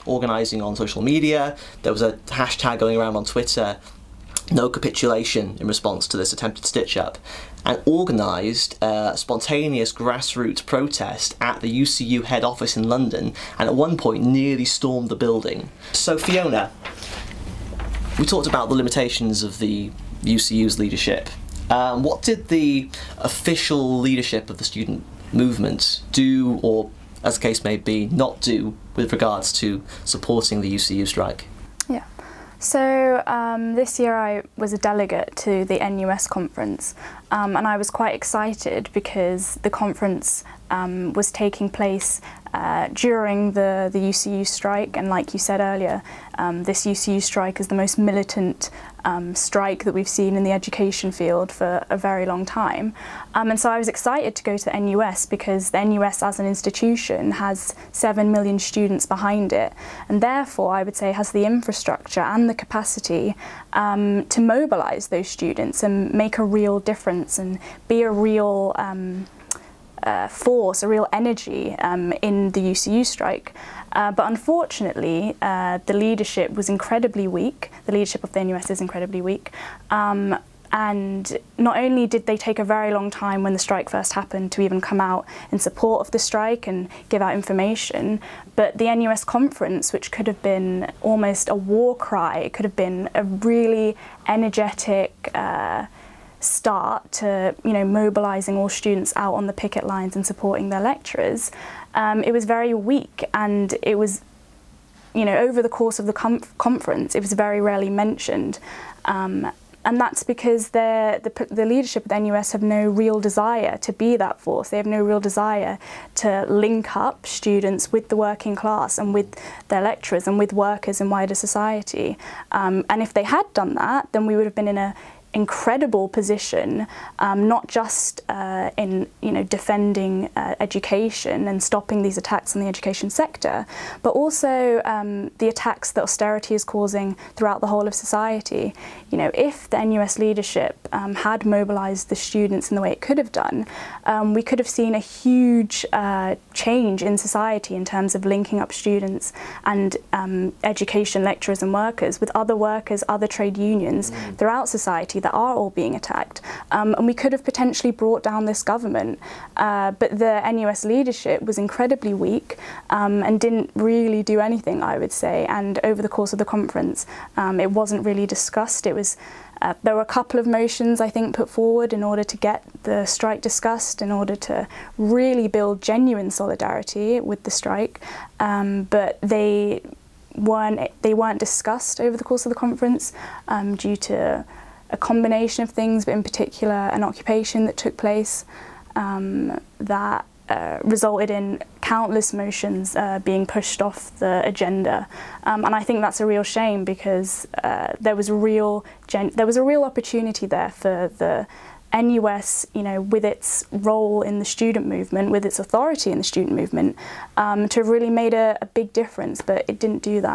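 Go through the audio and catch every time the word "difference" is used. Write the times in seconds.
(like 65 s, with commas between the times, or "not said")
66 s, 208 s.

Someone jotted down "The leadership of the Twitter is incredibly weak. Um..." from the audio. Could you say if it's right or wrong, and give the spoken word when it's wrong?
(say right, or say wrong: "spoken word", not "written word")
wrong: "NUS", not "Twitter".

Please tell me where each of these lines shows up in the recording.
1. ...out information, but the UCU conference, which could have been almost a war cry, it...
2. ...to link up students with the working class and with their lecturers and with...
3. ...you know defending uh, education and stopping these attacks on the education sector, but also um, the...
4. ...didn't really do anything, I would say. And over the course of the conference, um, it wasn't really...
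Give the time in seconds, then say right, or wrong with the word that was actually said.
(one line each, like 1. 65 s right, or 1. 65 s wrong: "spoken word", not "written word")
1. 87 s wrong: "NUS", not "UCU"
2. 116 s right
3. 129 s right
4. 163 s right.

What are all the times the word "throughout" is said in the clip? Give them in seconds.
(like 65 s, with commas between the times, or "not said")
137 s, 154 s.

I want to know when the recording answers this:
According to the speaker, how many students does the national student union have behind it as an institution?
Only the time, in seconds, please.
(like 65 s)
57 s.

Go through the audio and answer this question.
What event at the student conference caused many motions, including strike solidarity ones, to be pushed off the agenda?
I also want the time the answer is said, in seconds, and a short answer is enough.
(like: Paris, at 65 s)
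an occupation, at 186 s.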